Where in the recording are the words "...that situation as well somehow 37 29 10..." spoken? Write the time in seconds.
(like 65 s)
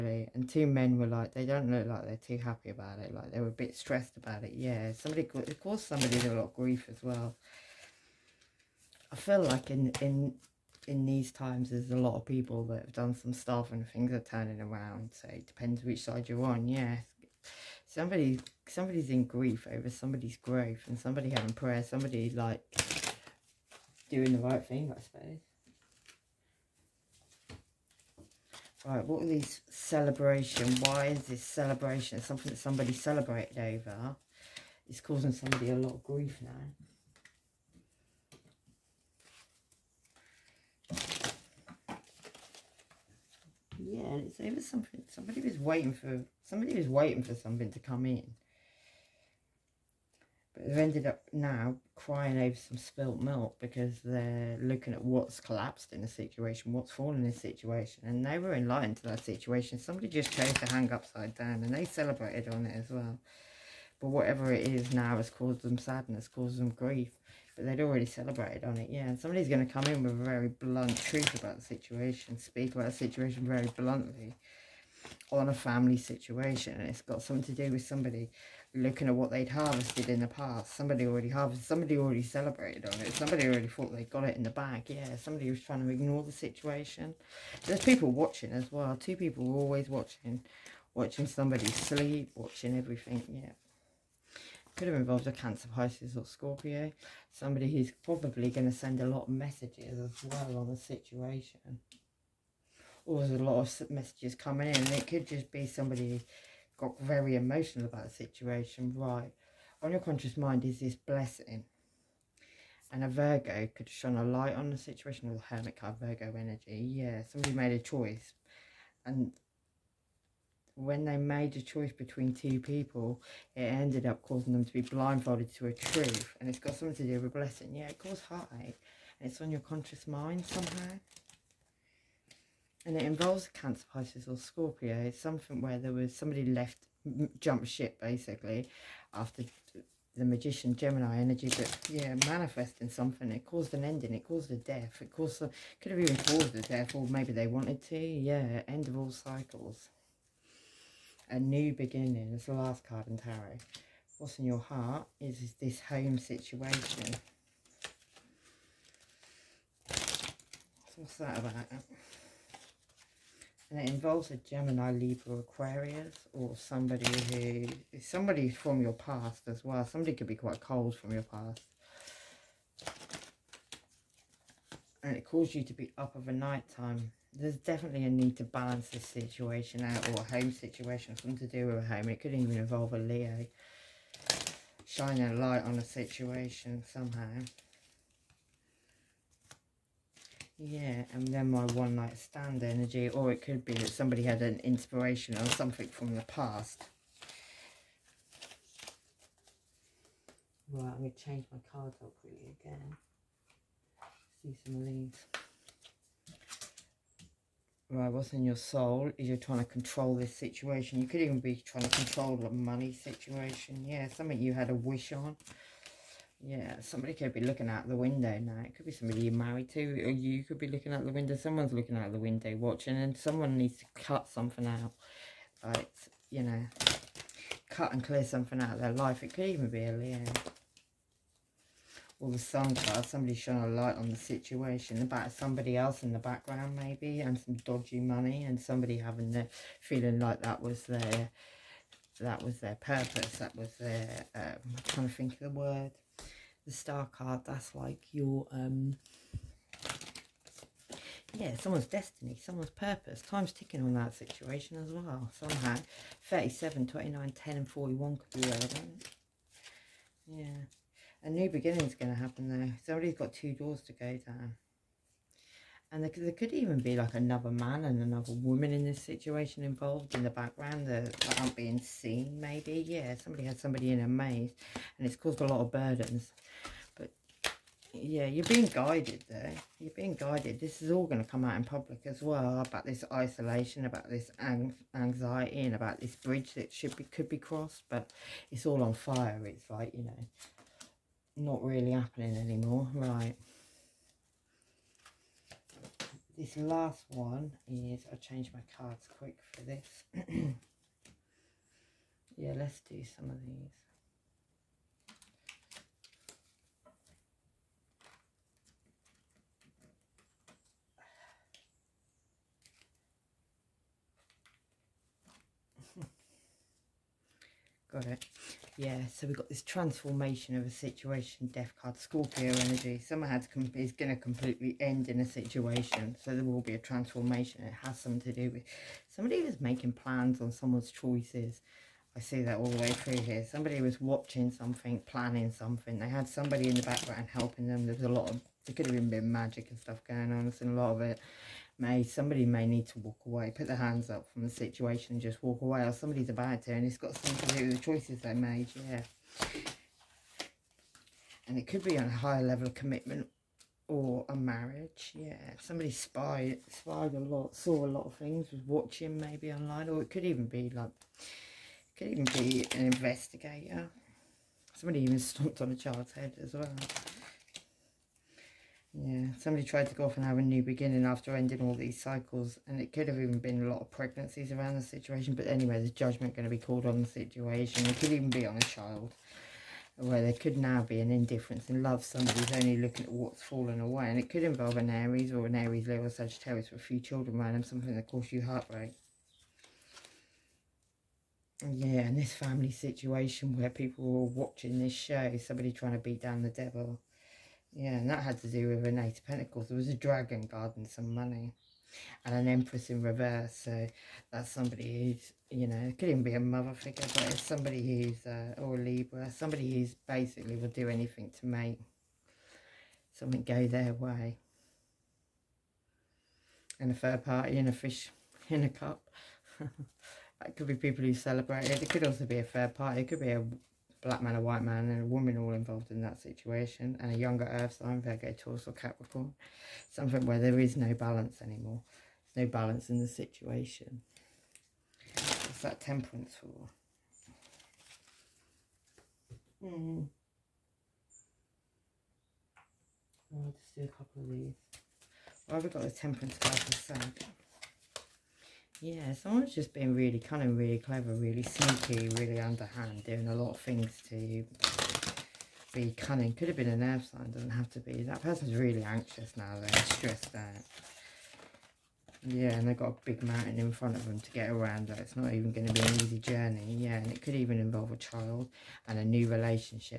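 253 s.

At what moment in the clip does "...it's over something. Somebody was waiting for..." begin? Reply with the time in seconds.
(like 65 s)
44 s.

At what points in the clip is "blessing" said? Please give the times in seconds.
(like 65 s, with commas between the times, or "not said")
110 s, 127 s.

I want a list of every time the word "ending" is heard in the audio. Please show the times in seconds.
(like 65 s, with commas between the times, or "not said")
143 s, 371 s.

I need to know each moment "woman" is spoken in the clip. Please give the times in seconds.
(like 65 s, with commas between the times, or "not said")
268 s, 425 s.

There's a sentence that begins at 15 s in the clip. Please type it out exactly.
So it depends which side you're on.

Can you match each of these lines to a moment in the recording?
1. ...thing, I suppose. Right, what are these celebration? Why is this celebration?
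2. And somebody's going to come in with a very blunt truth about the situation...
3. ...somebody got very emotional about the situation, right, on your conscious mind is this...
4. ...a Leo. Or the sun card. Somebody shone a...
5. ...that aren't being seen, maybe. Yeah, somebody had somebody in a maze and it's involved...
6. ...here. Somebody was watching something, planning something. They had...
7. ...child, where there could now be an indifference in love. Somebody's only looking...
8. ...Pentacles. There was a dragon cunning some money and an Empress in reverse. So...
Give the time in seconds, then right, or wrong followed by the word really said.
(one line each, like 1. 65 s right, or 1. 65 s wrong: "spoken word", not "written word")
1. 24 s right
2. 69 s right
3. 105 s right
4. 229 s right
5. 271 s wrong: "caused", not "involved"
6. 333 s right
7. 378 s right
8. 399 s wrong: "guarding", not "cunning".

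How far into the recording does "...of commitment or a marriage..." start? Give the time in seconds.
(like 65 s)
352 s.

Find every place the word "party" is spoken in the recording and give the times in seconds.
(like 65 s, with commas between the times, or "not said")
417 s, 422 s.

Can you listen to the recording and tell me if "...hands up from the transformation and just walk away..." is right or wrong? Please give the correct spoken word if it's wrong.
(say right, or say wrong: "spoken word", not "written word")
wrong: "situation", not "transformation".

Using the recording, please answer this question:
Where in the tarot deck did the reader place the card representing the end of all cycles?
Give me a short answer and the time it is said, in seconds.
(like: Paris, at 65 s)
The last card, at 152 s.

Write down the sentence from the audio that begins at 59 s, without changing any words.
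Somebody just chose to hang upside down and they celebrated on it as well.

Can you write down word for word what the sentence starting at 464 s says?
It's not even going to be an easy journey.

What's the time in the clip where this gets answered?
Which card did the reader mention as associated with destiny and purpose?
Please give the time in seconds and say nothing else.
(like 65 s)
246 s.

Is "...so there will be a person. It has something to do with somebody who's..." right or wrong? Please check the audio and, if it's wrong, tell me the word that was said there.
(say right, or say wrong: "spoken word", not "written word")
wrong: "transformation", not "person".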